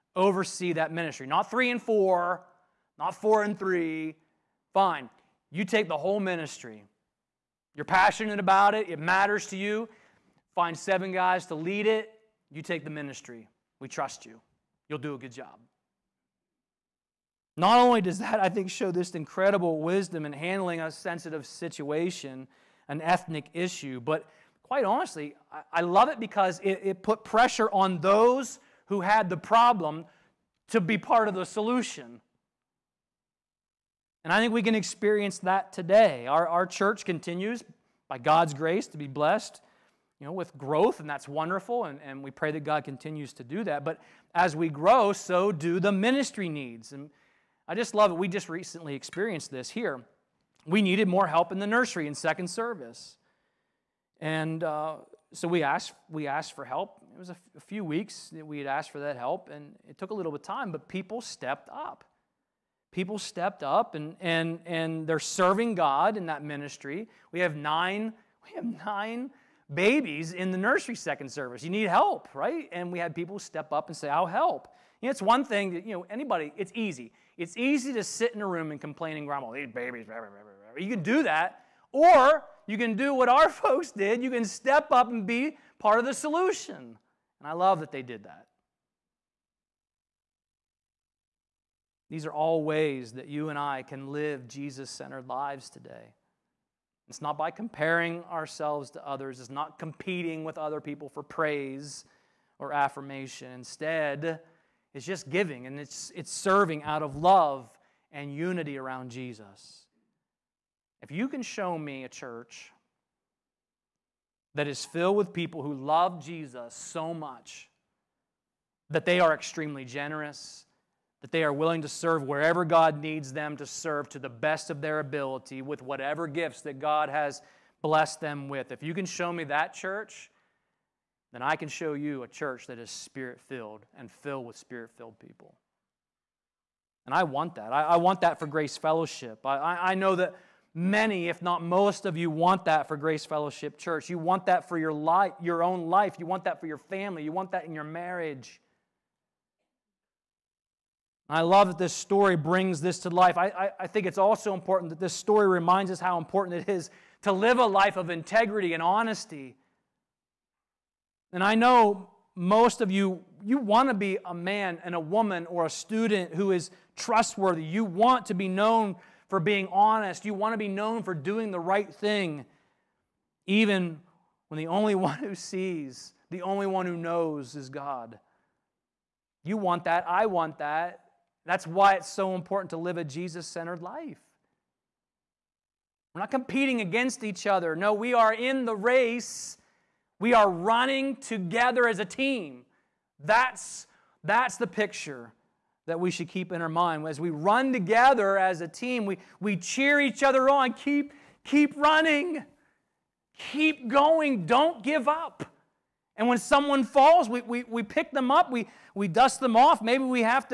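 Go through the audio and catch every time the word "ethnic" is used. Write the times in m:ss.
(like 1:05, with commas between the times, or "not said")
0:23.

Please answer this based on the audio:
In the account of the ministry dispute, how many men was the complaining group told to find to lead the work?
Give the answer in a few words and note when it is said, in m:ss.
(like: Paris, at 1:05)
7, at 0:10.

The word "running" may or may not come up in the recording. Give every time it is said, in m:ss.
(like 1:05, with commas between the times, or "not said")
3:10, 3:21.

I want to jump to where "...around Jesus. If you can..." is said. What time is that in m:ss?
1:48.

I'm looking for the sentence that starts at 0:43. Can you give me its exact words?
But as we grow, so do the ministry needs.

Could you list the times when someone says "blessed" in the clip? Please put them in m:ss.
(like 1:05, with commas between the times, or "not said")
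0:39, 2:07.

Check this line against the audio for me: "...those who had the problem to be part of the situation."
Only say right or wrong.
wrong.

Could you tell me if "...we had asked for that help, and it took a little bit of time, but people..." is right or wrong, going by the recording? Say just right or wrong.
right.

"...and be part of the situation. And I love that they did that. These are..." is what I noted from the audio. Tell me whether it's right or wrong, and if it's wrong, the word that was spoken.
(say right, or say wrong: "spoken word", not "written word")
wrong: "solution", not "situation".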